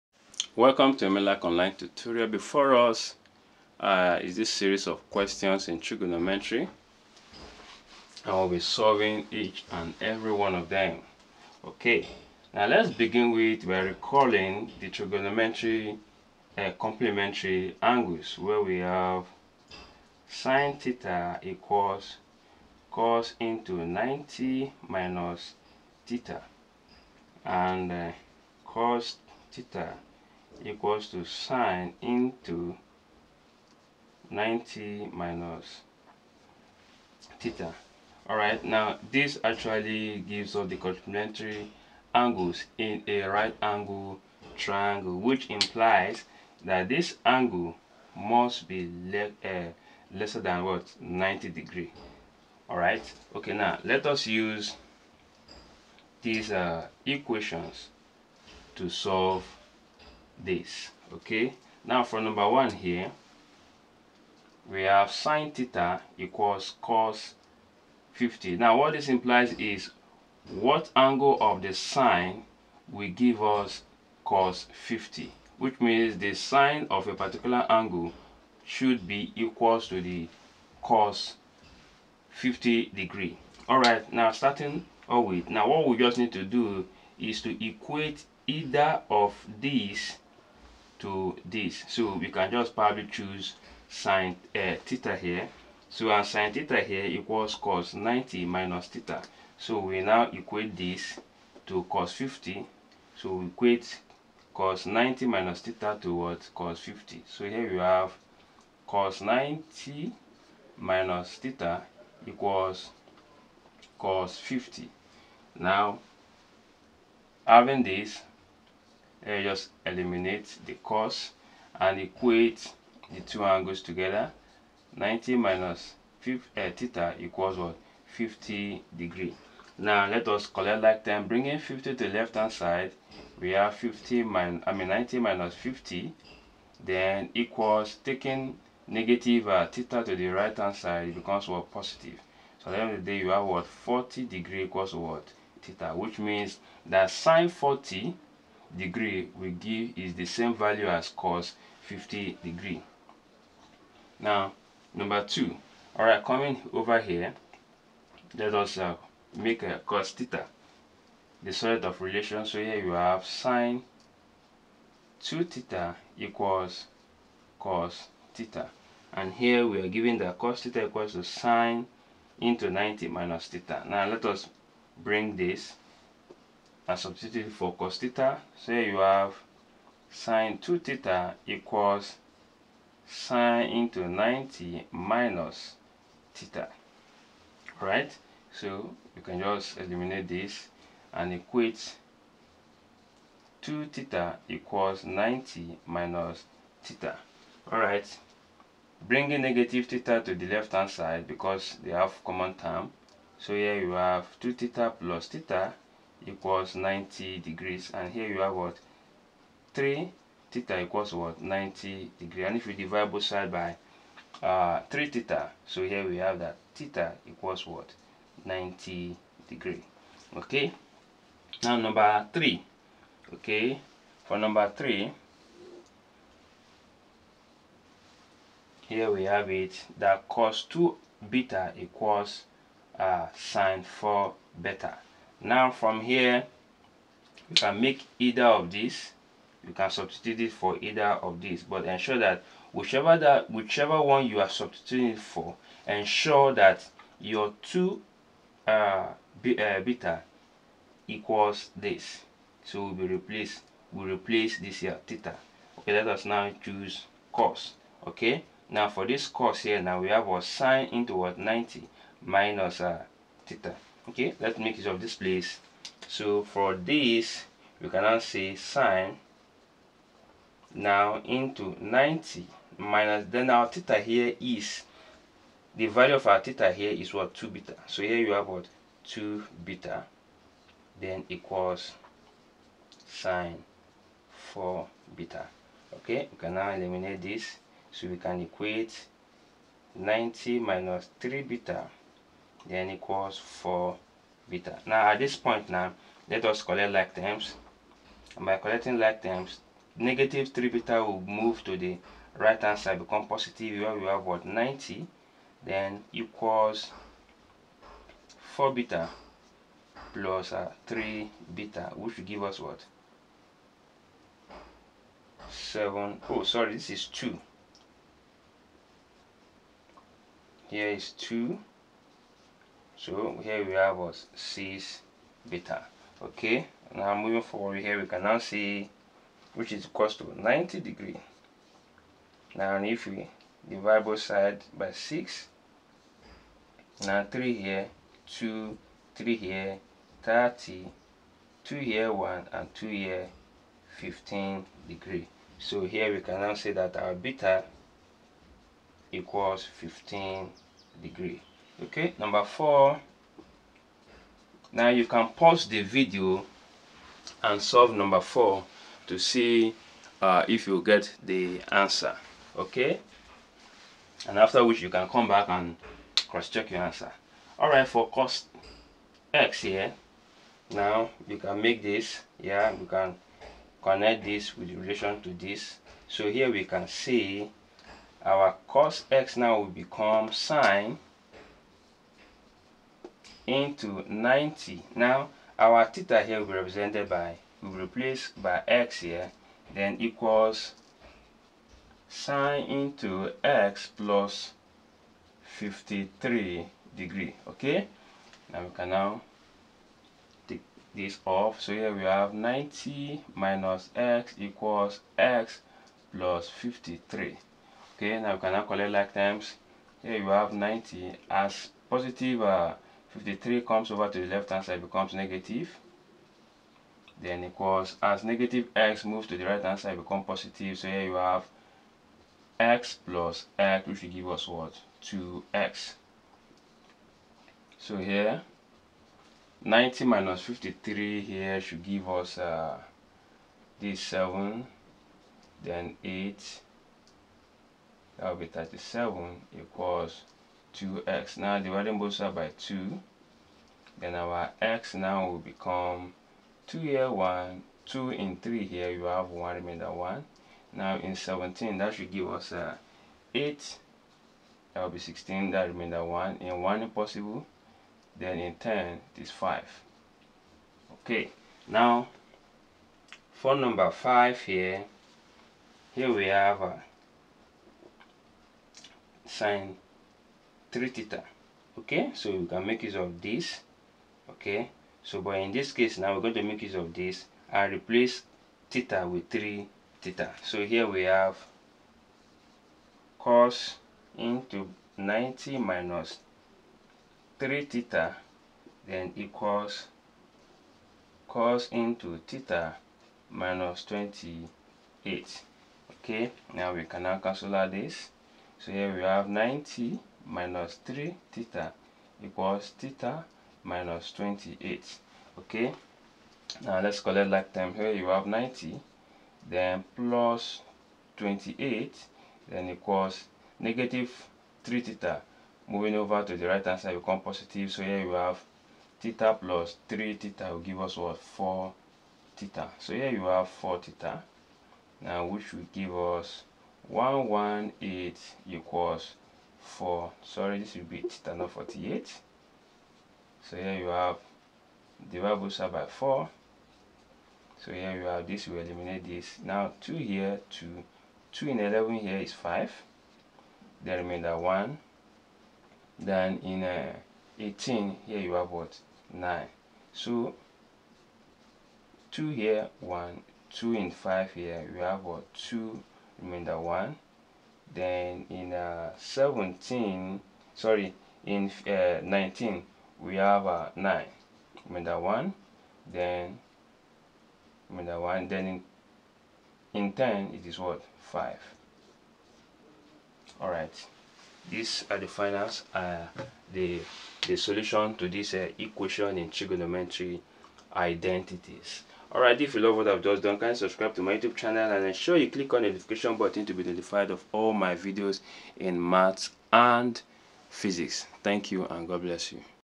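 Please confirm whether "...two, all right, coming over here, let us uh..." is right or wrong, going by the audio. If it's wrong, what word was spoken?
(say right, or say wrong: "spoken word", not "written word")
right.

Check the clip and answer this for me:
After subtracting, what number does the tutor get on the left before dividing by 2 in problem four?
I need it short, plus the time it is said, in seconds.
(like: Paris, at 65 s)
37, at 438 s.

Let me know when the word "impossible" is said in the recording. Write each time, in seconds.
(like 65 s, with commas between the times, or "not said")
456 s.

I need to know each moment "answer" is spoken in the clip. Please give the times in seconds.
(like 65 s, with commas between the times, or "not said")
361 s, 366 s.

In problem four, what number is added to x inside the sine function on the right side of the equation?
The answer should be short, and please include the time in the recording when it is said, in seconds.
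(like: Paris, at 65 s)
53 degrees, at 395 s.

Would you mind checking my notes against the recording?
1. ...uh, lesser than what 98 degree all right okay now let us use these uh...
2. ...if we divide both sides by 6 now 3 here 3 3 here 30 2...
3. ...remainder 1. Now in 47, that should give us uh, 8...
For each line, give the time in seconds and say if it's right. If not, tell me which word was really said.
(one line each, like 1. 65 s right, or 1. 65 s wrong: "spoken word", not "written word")
1. 49 s wrong: "90", not "98"
2. 332 s wrong: "2", not "3"
3. 449 s wrong: "17", not "47".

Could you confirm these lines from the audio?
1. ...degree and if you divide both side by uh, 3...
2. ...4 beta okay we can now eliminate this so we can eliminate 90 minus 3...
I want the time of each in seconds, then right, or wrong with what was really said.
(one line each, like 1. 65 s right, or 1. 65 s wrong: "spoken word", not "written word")
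1. 212 s right
2. 284 s wrong: "equate", not "eliminate".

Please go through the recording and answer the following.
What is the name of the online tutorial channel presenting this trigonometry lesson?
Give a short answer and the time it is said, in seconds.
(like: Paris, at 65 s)
Emmelac, at 1 s.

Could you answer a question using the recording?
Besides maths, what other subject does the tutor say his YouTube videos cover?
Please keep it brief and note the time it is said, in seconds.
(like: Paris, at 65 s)
physics, at 590 s.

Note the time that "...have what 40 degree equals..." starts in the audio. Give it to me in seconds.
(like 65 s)
143 s.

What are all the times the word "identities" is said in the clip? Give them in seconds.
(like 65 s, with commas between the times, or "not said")
580 s.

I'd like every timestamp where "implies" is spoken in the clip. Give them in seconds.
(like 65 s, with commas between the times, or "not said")
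45 s, 69 s.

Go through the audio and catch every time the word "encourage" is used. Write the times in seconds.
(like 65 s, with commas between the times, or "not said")
not said.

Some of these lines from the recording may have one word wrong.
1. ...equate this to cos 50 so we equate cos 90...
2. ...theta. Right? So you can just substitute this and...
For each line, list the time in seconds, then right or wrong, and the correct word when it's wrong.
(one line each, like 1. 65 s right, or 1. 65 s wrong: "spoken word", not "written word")
1. 100 s right
2. 186 s wrong: "eliminate", not "substitute".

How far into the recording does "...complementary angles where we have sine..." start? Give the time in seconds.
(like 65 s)
16 s.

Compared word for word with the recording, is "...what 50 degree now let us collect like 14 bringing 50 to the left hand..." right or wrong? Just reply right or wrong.
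wrong.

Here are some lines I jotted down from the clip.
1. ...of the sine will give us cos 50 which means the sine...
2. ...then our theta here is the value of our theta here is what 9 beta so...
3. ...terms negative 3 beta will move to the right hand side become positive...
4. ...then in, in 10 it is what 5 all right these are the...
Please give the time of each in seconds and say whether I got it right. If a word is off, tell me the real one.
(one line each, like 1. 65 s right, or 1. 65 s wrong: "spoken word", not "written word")
1. 71 s right
2. 273 s wrong: "2", not "9"
3. 299 s right
4. 568 s right.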